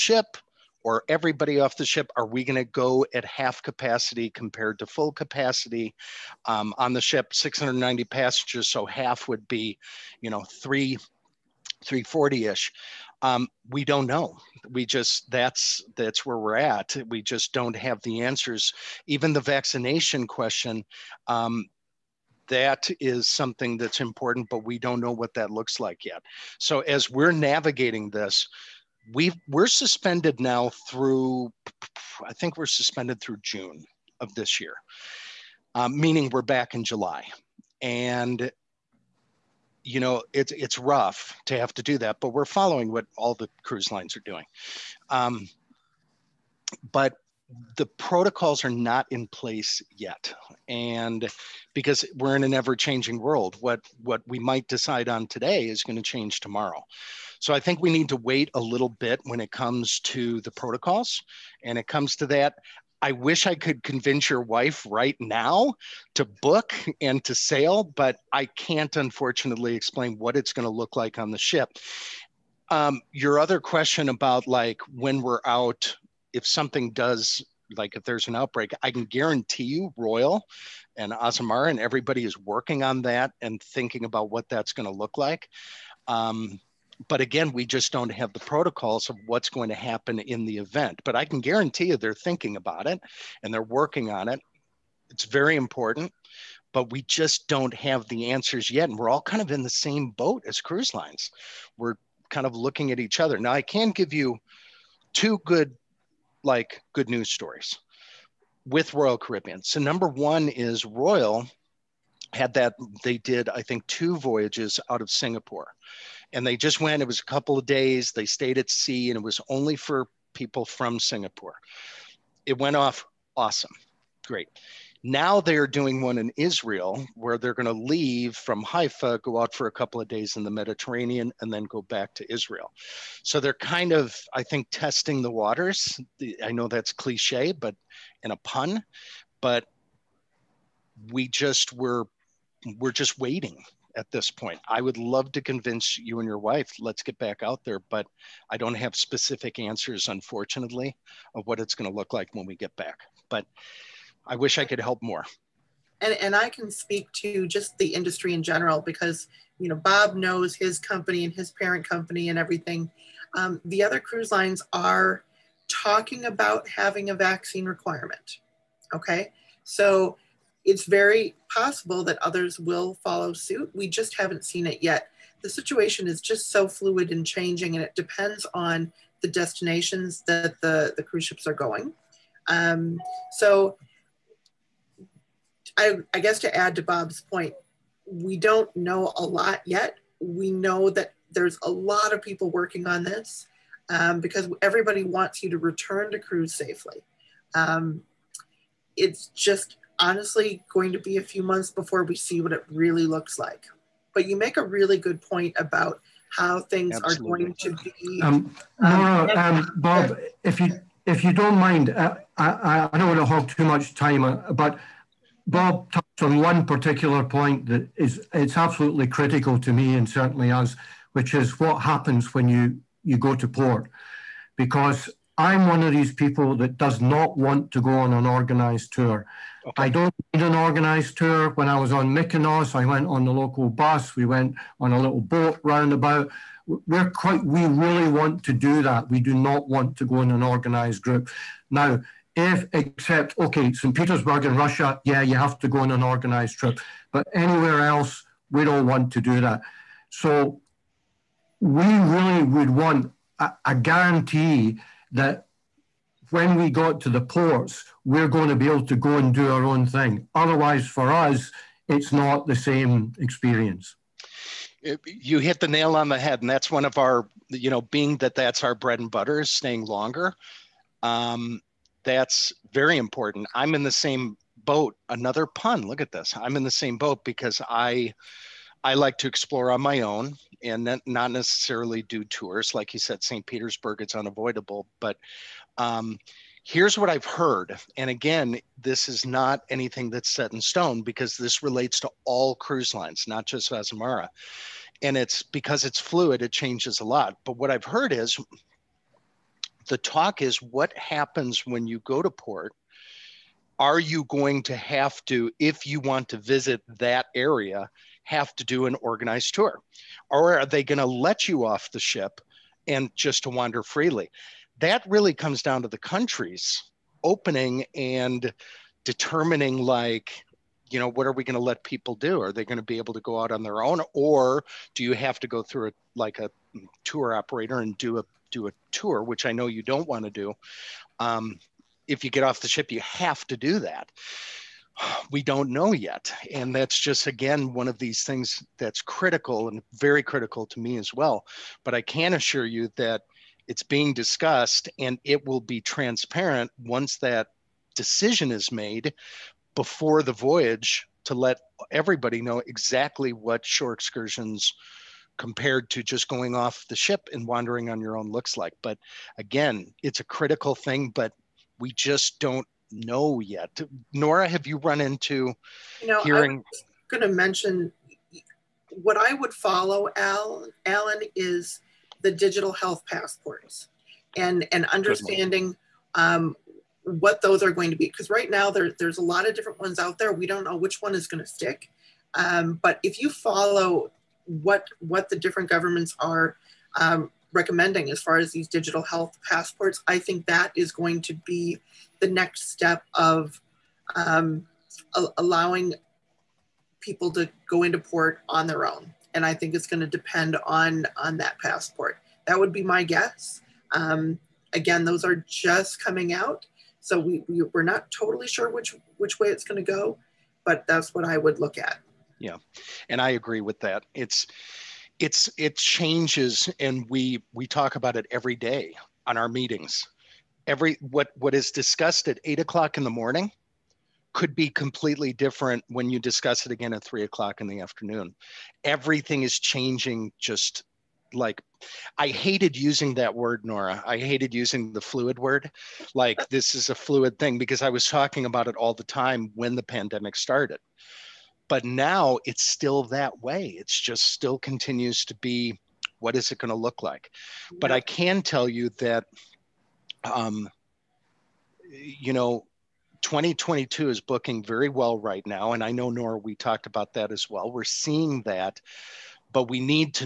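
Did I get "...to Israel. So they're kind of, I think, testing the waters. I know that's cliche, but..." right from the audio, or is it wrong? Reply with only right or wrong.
right.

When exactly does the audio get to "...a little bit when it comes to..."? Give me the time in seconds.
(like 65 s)
58 s.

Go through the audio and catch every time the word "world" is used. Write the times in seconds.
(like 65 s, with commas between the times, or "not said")
53 s.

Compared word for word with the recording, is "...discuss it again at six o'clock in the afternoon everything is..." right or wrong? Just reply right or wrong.
wrong.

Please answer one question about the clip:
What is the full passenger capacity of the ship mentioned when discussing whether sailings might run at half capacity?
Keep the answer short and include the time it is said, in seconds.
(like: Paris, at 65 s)
690, at 7 s.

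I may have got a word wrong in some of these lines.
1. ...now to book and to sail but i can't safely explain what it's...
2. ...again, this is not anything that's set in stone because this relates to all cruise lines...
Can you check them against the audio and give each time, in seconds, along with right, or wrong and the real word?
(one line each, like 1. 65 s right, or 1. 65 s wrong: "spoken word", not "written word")
1. 65 s wrong: "unfortunately", not "safely"
2. 288 s right.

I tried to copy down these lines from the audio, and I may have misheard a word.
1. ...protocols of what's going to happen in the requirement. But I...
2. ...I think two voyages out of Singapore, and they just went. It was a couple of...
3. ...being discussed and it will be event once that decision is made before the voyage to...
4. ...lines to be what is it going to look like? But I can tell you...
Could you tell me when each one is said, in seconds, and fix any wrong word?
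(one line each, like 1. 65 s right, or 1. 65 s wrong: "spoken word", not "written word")
1. 88 s wrong: "event", not "requirement"
2. 113 s right
3. 343 s wrong: "transparent", not "event"
4. 444 s wrong: "continues", not "lines".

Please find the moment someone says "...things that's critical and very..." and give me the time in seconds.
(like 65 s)
338 s.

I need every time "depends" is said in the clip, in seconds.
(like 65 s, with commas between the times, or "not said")
177 s, 400 s.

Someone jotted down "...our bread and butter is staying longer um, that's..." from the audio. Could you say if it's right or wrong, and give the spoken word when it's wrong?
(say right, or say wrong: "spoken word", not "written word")
right.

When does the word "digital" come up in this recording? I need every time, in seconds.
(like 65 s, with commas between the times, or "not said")
372 s, 388 s.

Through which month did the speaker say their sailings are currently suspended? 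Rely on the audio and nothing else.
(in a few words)
June.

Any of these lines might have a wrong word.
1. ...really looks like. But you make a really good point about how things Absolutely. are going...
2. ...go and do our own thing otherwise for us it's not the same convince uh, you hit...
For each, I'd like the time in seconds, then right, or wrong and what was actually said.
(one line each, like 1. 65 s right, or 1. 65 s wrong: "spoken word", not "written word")
1. 202 s right
2. 258 s wrong: "experience", not "convince".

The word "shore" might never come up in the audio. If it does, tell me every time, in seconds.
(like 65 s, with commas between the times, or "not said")
353 s.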